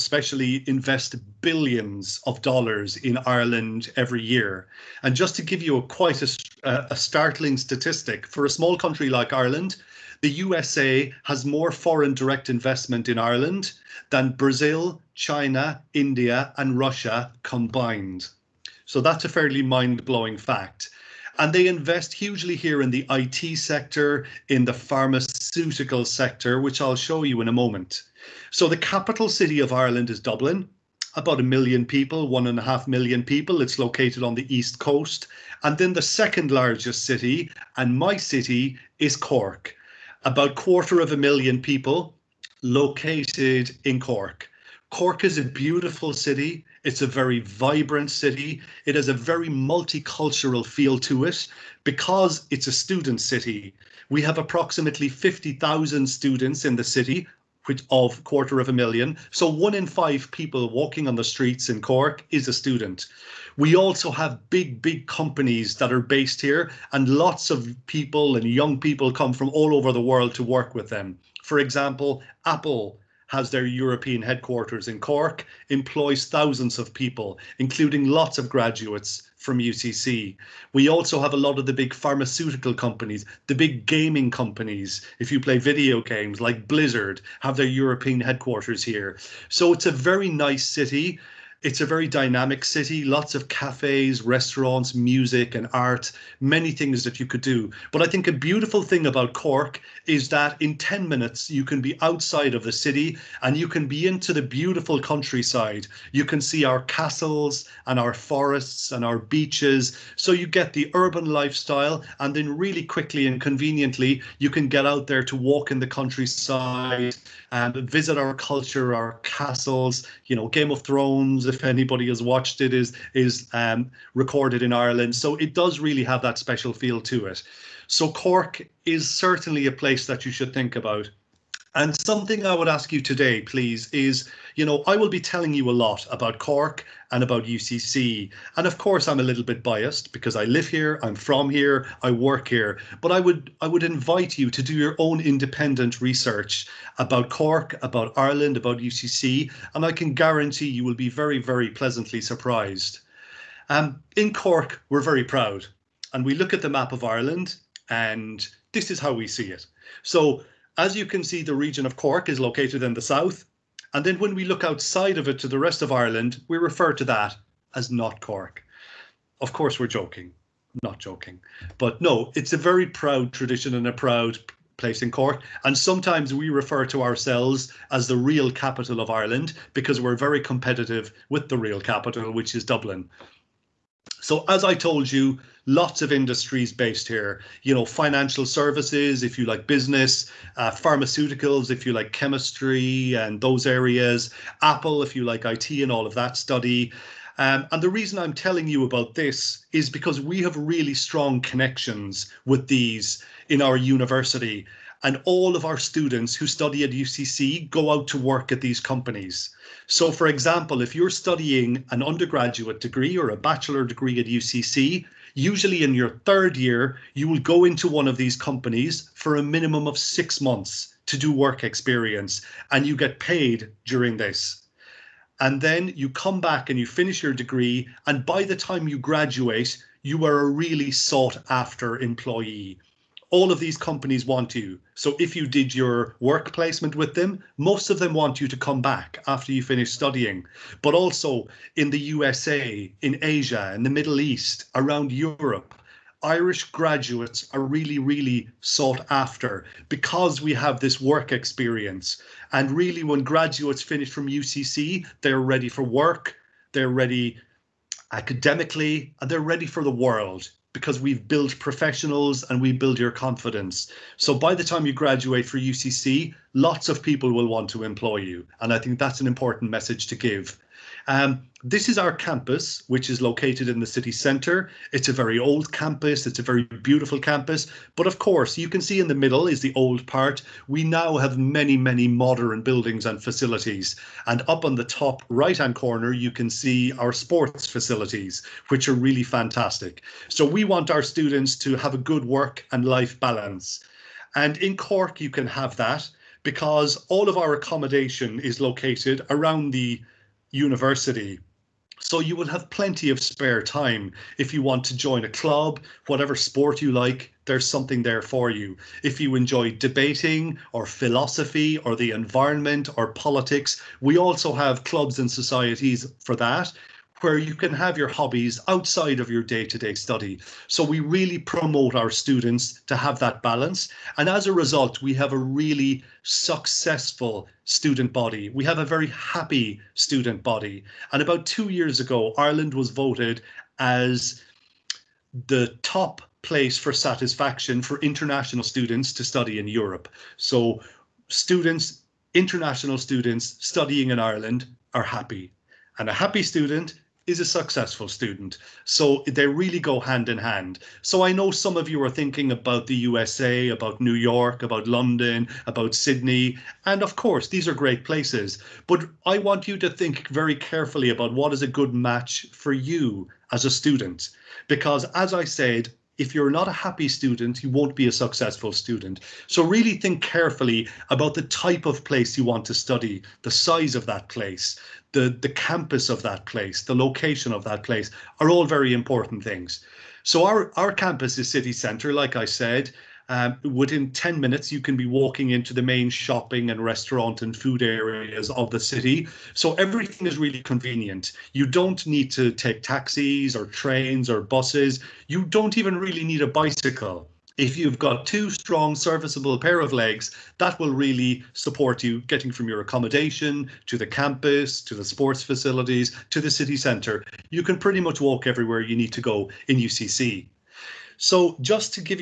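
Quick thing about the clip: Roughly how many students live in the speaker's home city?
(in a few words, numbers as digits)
50,000.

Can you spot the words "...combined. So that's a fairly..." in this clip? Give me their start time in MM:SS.
00:17.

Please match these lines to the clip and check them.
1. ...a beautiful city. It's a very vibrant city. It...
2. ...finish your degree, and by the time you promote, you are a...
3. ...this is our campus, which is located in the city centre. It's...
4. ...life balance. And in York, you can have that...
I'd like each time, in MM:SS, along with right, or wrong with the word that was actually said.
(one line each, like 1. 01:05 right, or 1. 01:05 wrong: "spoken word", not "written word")
1. 00:45 right
2. 03:46 wrong: "graduate", not "promote"
3. 04:31 right
4. 04:52 wrong: "Cork", not "York".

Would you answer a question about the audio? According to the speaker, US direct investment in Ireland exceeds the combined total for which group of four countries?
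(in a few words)
Brazil, China, India, and Russia.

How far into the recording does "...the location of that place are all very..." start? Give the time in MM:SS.
06:16.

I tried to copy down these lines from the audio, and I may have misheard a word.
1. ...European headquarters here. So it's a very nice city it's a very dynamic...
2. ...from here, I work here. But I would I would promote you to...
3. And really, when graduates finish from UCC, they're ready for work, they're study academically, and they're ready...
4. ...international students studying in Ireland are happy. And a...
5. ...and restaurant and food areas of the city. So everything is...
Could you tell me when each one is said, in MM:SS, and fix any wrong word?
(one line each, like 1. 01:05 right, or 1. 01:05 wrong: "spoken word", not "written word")
1. 01:27 right
2. 02:21 wrong: "invite", not "promote"
3. 04:12 wrong: "ready", not "study"
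4. 05:42 right
5. 06:26 right.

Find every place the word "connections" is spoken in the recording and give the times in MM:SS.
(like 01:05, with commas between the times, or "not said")
03:21.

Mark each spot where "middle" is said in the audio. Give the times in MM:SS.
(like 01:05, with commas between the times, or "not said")
04:03, 04:39.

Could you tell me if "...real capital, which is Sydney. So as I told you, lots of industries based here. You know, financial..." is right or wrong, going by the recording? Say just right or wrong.
wrong.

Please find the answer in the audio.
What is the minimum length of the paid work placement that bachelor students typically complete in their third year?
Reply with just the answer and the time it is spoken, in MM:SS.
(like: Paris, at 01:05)
6 months, at 03:39.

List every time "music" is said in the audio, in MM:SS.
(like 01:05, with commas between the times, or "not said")
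01:34.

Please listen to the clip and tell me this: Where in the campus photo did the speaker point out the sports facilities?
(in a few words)
Top right hand corner.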